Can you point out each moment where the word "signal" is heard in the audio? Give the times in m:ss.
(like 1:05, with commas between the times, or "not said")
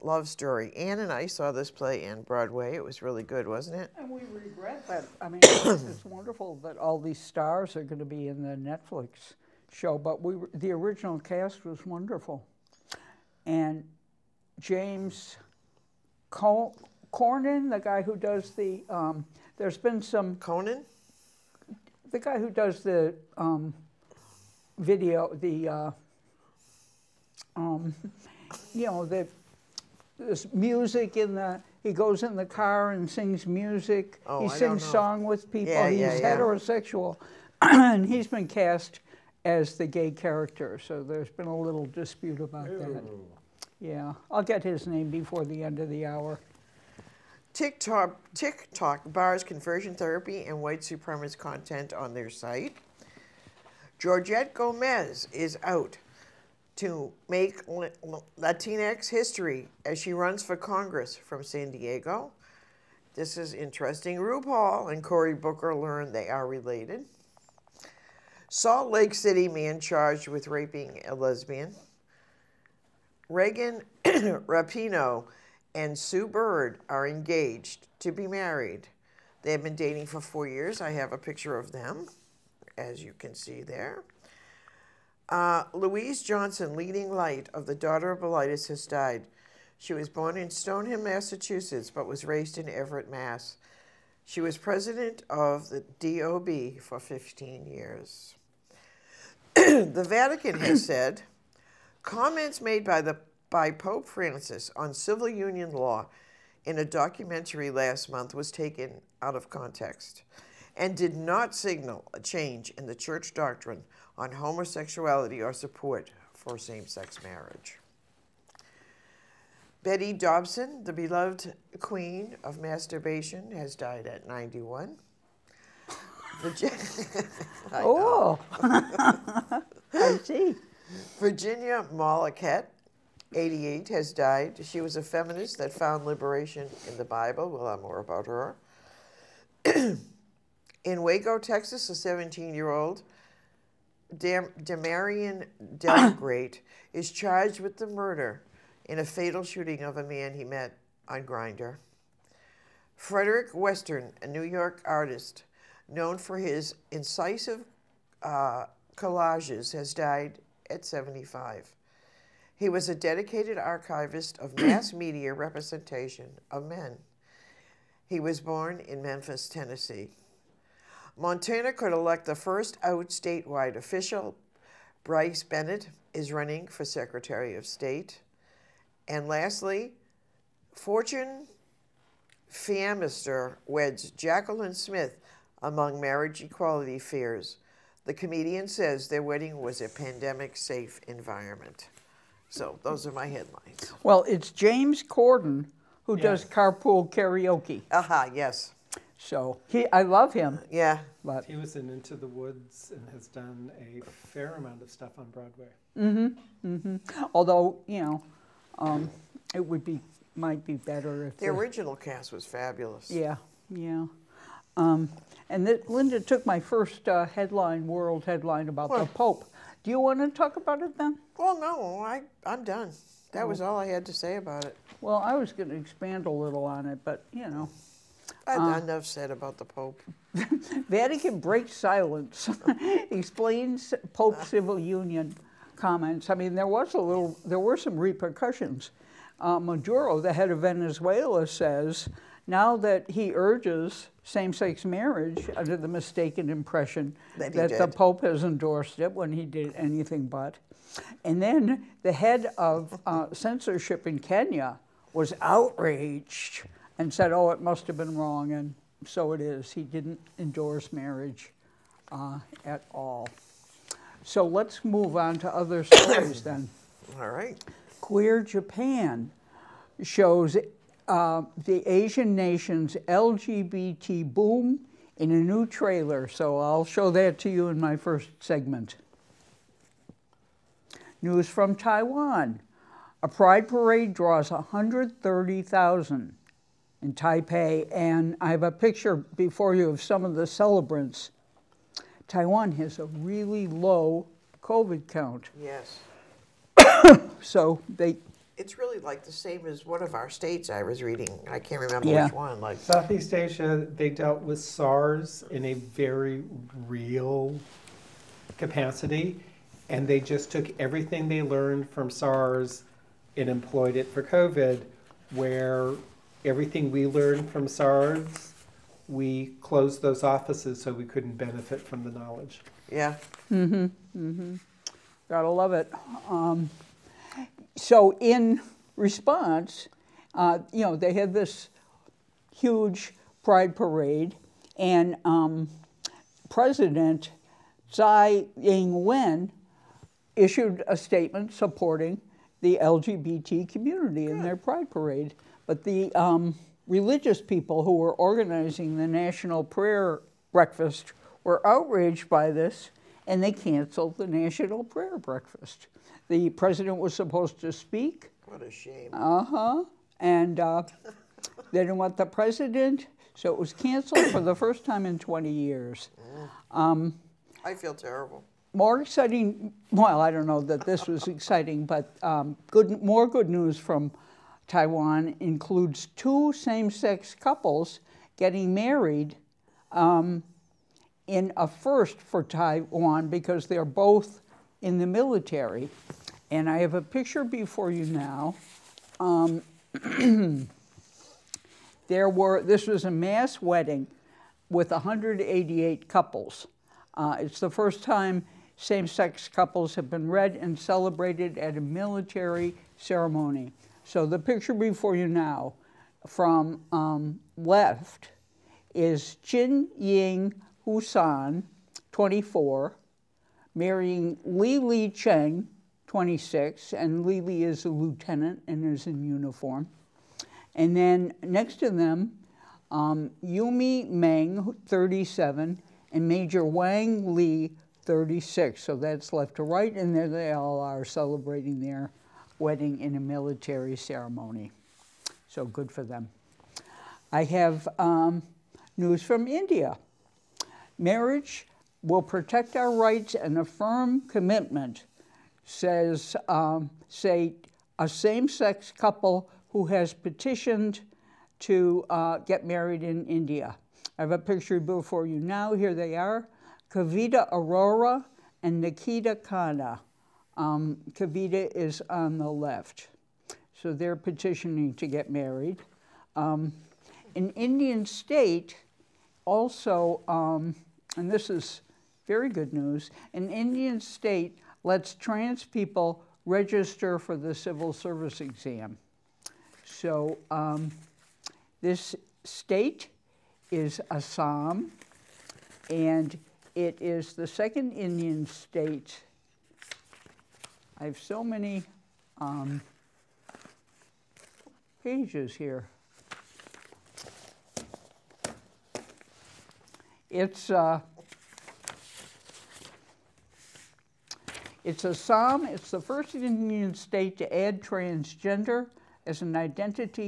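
1:51.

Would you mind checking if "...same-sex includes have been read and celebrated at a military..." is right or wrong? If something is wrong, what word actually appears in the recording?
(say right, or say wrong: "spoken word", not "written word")
wrong: "couples", not "includes".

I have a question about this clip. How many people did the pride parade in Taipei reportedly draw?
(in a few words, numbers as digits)
130,000.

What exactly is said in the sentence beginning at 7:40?
Um, Kavita is on the left.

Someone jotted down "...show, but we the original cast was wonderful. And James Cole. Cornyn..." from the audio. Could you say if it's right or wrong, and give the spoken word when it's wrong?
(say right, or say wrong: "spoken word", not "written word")
right.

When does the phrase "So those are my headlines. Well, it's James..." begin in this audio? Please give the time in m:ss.
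3:12.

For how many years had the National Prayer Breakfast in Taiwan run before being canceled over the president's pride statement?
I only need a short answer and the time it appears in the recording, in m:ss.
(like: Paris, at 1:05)
20, at 6:05.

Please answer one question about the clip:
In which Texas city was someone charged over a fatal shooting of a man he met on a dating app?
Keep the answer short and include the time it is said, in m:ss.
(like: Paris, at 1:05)
Waco, at 2:21.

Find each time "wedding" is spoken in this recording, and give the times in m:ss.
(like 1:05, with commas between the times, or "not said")
3:09, 6:33, 7:12.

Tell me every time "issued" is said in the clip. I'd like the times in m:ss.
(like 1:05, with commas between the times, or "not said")
5:40.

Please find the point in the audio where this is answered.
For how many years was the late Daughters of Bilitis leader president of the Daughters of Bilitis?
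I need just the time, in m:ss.
1:36.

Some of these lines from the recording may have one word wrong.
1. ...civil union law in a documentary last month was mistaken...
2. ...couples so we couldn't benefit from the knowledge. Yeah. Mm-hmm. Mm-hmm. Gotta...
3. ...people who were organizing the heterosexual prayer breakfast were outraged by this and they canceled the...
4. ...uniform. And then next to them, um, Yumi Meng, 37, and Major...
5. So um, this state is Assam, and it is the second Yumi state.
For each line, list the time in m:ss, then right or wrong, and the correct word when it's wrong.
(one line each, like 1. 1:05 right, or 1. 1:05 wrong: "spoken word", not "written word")
1. 1:44 wrong: "taken", not "mistaken"
2. 5:20 wrong: "offices", not "couples"
3. 5:47 wrong: "national", not "heterosexual"
4. 6:59 right
5. 7:59 wrong: "Indian", not "Yumi".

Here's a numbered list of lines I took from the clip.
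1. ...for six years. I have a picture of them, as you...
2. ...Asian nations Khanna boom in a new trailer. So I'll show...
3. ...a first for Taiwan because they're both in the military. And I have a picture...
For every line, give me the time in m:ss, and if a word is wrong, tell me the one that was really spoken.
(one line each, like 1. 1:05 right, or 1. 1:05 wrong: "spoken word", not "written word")
1. 1:20 wrong: "four", not "six"
2. 4:31 wrong: "LGBT", not "Khanna"
3. 6:21 right.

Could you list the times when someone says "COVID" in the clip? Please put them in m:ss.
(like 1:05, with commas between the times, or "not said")
4:54, 5:14.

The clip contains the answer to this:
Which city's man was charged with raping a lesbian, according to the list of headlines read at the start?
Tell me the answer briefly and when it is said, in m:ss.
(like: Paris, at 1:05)
Salt Lake City, at 1:08.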